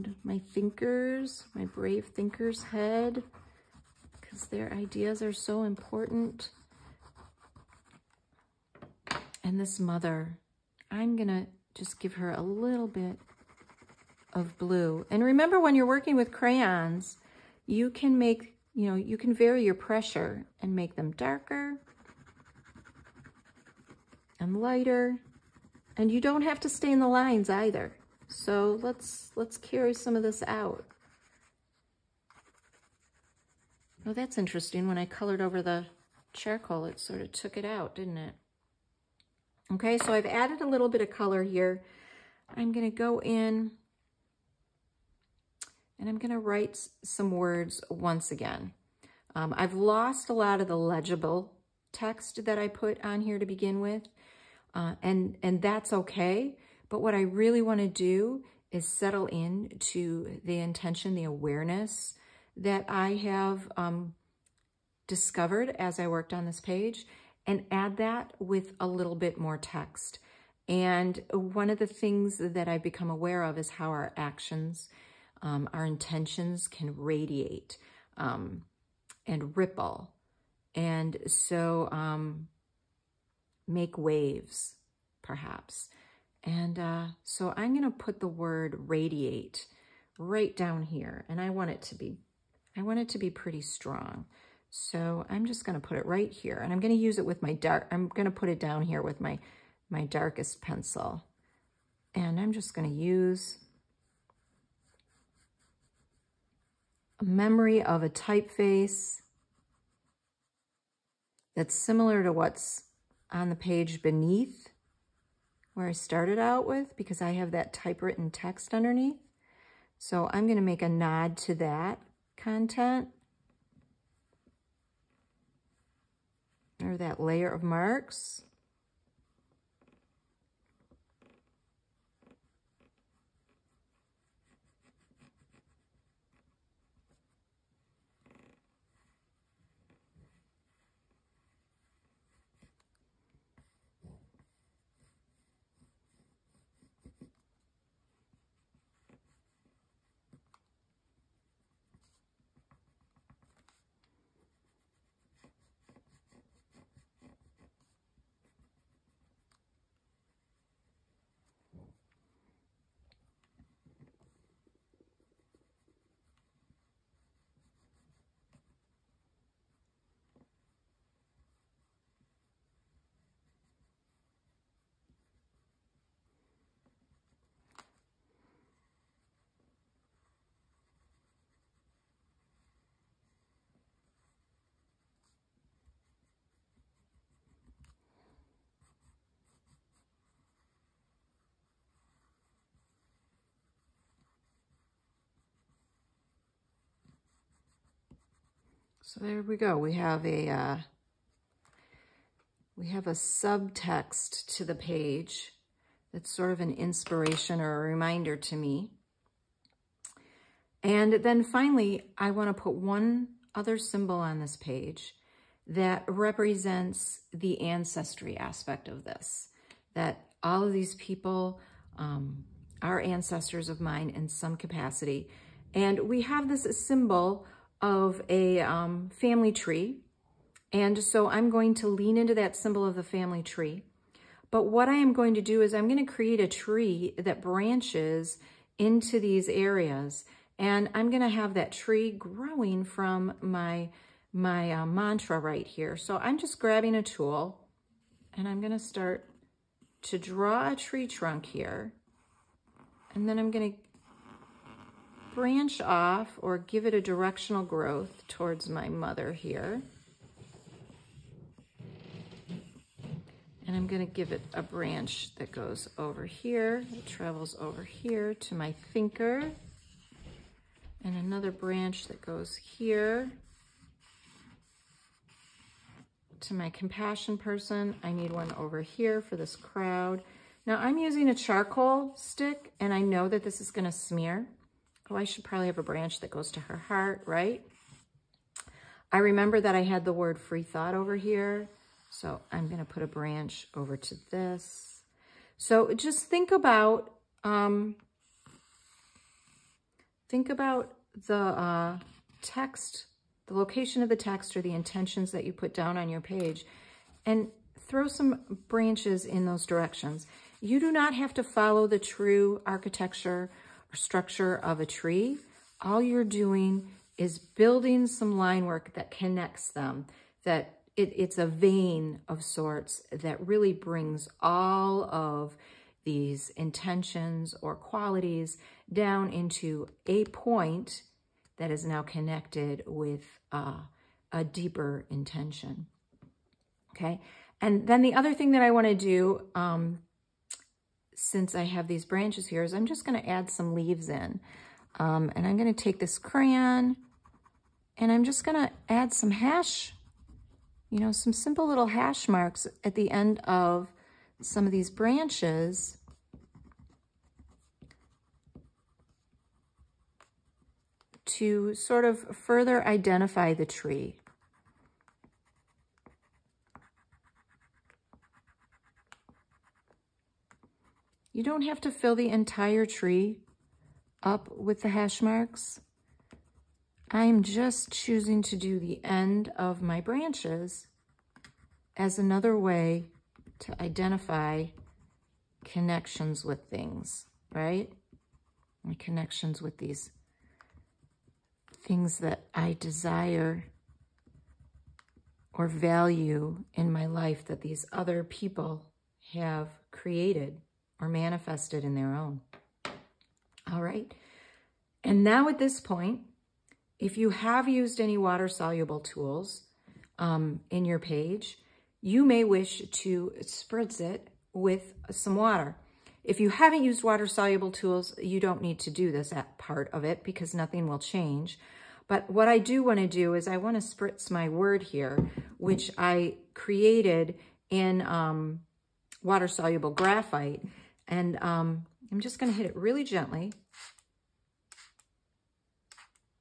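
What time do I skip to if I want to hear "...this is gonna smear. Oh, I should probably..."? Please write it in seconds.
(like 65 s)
283 s.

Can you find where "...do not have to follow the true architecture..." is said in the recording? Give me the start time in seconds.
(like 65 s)
310 s.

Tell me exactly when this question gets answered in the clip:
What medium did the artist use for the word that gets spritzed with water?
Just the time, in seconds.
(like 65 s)
429 s.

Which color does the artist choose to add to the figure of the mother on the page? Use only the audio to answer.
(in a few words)
blue.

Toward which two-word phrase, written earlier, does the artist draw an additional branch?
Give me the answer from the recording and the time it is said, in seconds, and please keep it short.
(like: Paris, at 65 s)
free thought, at 290 s.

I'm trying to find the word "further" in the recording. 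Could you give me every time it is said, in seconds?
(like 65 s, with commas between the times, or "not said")
362 s.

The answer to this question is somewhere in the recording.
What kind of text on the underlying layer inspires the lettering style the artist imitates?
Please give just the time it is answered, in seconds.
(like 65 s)
117 s.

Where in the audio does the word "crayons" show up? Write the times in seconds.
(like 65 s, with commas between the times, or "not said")
16 s, 346 s.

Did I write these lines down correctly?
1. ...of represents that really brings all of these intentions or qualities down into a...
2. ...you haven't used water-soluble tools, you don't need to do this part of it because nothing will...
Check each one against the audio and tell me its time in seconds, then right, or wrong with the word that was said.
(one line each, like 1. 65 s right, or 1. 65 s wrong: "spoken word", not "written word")
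1. 322 s wrong: "sorts", not "represents"
2. 416 s right.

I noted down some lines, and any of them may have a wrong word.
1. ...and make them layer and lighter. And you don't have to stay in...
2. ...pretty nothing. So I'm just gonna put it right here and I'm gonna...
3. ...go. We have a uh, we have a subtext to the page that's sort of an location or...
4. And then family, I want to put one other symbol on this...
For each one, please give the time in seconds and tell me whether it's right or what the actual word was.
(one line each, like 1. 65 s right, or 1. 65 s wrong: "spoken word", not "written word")
1. 20 s wrong: "darker", not "layer"
2. 93 s wrong: "strong", not "nothing"
3. 199 s wrong: "inspiration", not "location"
4. 210 s wrong: "finally", not "family".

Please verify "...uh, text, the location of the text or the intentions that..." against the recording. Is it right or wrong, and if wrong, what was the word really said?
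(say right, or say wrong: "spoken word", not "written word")
right.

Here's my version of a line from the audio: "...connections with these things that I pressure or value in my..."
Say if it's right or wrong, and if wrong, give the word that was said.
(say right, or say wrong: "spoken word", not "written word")
wrong: "desire", not "pressure".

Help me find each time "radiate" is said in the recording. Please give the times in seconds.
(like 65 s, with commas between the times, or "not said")
76 s, 88 s.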